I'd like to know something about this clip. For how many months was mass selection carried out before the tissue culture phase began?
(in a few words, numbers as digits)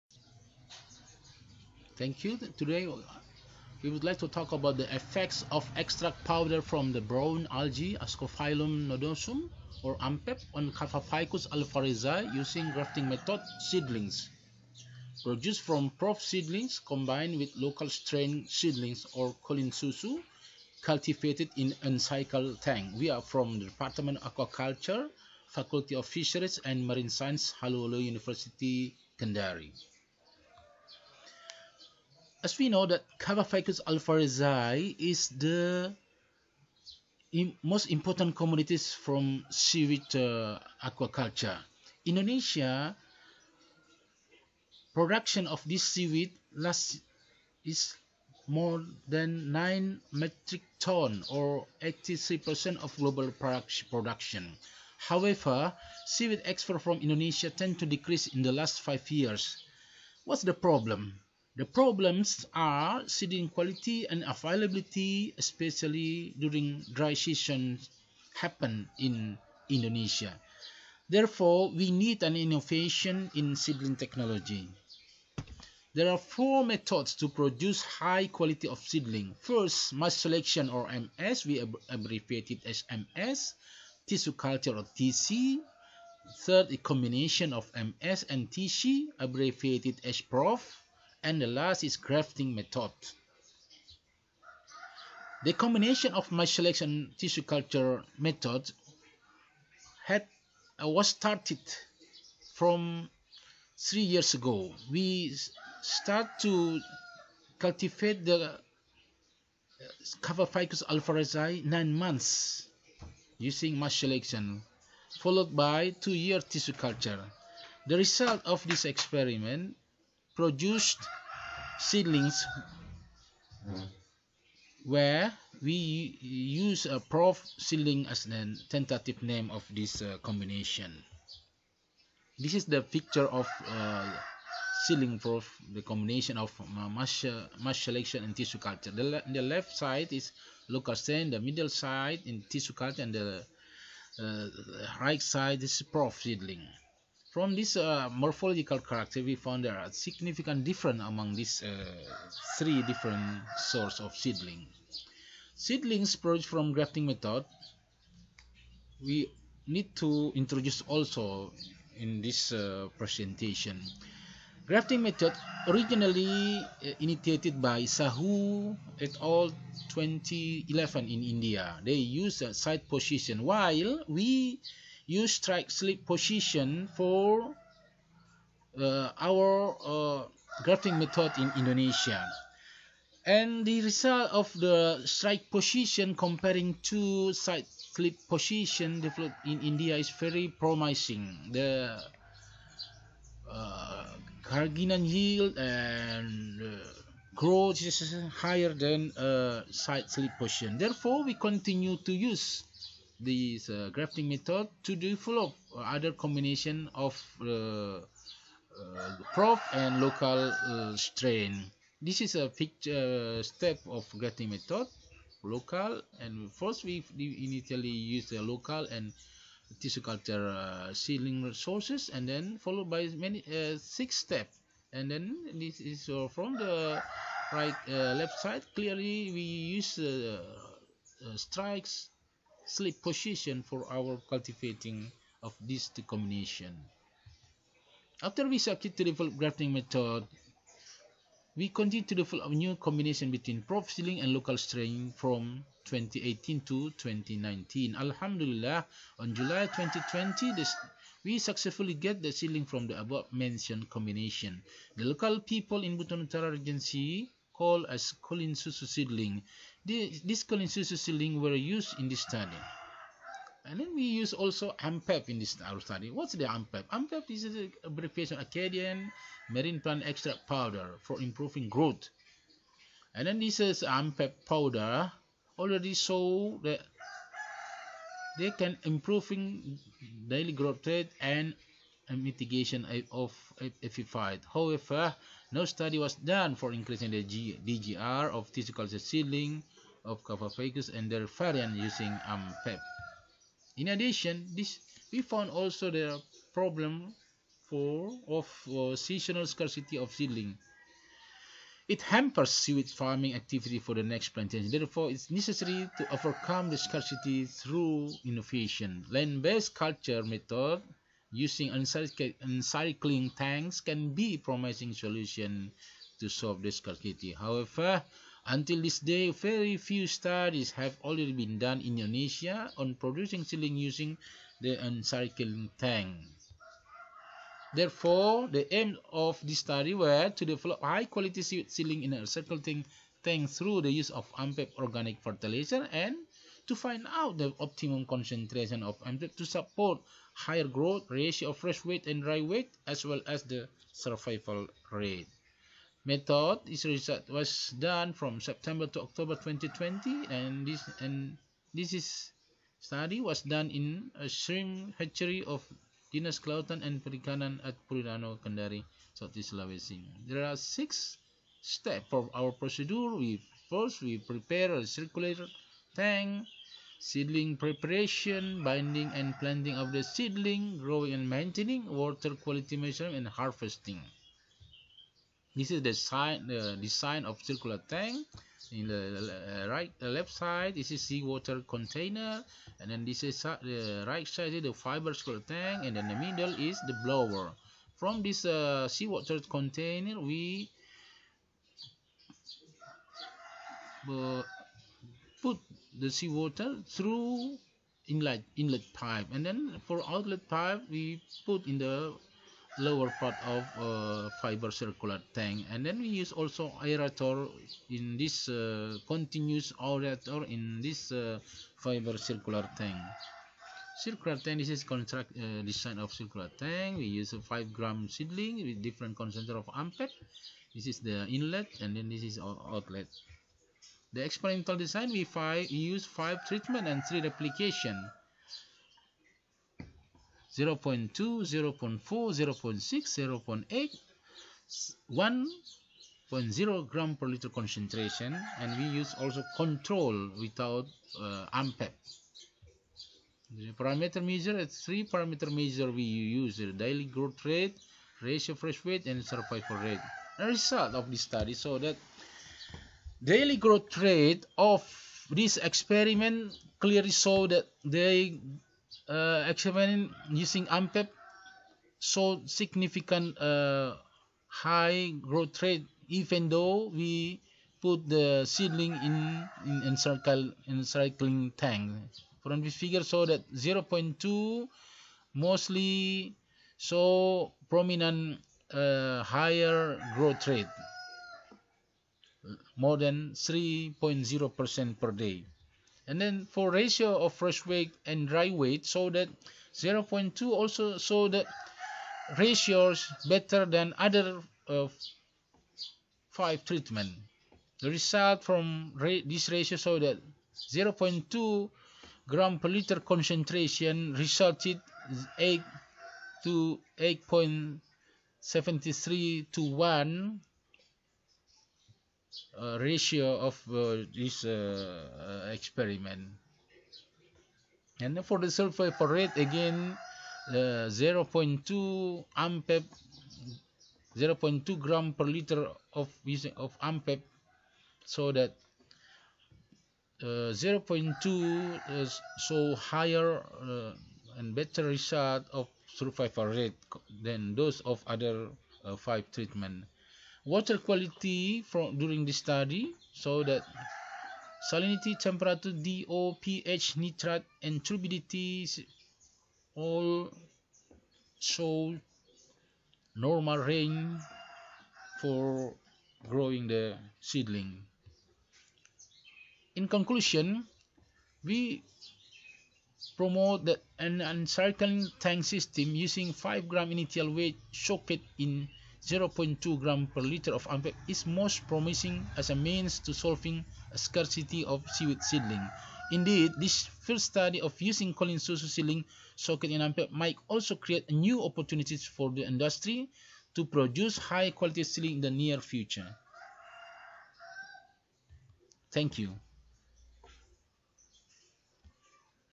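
nine months.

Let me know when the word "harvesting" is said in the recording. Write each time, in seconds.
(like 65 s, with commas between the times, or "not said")
373 s.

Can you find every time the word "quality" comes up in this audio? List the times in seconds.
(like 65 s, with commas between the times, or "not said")
63 s, 78 s, 330 s, 372 s, 540 s, 584 s.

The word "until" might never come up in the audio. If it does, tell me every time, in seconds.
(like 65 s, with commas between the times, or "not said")
318 s.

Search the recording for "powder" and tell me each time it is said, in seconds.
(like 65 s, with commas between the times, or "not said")
6 s, 270 s, 274 s.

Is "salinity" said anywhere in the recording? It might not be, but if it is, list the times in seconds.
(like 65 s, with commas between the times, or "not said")
544 s.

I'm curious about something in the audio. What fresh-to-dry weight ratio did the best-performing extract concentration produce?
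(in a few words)
8.73 to 1.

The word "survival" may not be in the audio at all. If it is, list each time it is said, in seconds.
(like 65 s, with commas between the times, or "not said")
343 s, 449 s.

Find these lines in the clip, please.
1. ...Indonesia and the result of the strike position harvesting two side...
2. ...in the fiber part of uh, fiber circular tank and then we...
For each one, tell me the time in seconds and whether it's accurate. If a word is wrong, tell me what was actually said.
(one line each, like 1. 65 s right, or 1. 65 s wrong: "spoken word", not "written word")
1. 181 s wrong: "comparing", not "harvesting"
2. 401 s wrong: "lower", not "fiber".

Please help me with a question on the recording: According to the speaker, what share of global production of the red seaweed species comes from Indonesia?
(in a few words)
83%.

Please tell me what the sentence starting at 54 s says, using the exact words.
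However, seaweed export from Indonesia tend to decrease in the last 5 years.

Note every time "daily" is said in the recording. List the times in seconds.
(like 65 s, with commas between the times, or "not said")
280 s, 446 s, 453 s.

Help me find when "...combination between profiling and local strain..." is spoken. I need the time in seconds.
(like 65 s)
242 s.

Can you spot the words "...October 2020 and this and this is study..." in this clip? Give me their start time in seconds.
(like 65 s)
349 s.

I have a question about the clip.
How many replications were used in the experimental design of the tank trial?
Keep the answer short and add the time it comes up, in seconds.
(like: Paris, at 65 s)
3, at 427 s.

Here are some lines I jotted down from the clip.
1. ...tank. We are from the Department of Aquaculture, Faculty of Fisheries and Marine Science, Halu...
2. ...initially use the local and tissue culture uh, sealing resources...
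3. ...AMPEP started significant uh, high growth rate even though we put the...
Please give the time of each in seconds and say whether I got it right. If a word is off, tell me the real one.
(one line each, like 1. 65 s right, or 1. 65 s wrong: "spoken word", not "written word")
1. 22 s right
2. 217 s right
3. 460 s wrong: "showed", not "started".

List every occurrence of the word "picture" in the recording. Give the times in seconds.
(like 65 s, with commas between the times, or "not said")
132 s, 212 s.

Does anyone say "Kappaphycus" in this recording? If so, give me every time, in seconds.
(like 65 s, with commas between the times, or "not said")
10 s, 33 s.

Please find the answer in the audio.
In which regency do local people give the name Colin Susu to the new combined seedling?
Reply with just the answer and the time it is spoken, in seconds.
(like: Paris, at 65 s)
Buton Utara, at 255 s.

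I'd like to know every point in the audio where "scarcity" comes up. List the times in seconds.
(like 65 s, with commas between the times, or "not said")
299 s, 306 s, 316 s, 573 s.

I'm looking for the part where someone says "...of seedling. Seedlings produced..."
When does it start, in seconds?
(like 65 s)
154 s.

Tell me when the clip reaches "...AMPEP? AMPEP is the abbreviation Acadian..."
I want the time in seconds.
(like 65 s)
266 s.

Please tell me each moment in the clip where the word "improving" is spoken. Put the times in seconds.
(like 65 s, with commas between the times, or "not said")
271 s, 278 s.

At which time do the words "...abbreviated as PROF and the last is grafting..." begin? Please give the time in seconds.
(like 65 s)
89 s.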